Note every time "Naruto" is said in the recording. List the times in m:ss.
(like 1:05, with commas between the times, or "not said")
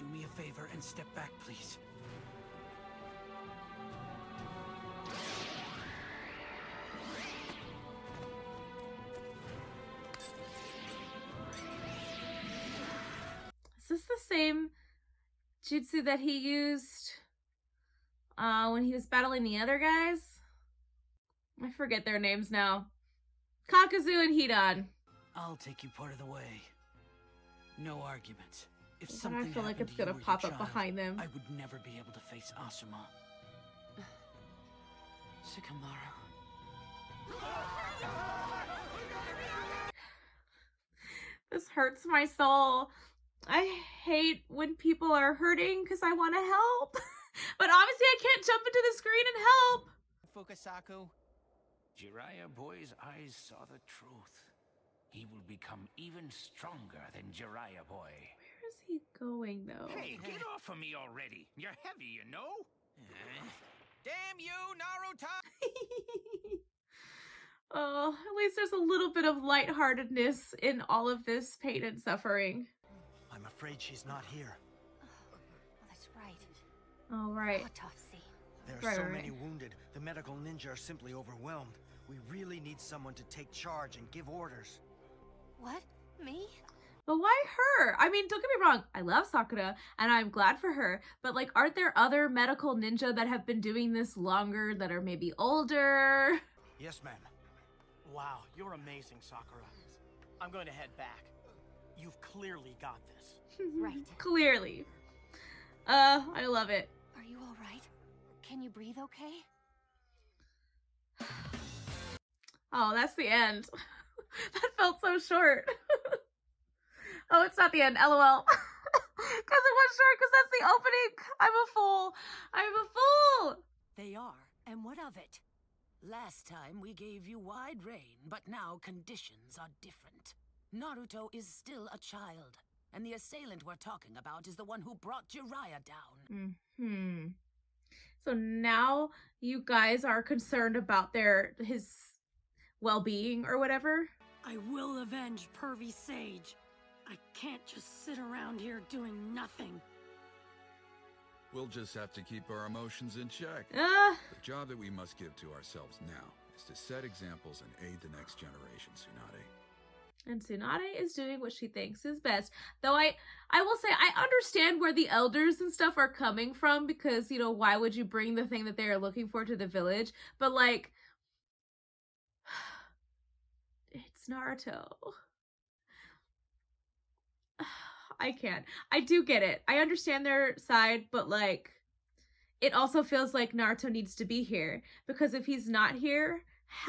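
1:04, 2:10, 2:54, 3:03.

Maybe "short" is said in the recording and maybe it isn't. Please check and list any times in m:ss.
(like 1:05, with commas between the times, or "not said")
1:55, 1:59.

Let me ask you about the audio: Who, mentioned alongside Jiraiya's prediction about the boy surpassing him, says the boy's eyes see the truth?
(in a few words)
Fukasaku.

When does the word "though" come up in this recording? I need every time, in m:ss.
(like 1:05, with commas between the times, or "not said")
0:59, 2:42.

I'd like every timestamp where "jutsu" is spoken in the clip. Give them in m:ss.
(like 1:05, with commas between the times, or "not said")
0:15.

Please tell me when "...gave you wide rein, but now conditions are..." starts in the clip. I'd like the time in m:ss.
2:06.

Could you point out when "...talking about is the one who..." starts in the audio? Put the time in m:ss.
2:13.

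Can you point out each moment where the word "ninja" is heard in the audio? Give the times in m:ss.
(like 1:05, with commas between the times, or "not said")
1:20, 1:32.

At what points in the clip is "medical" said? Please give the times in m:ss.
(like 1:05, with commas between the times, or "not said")
1:19, 1:32.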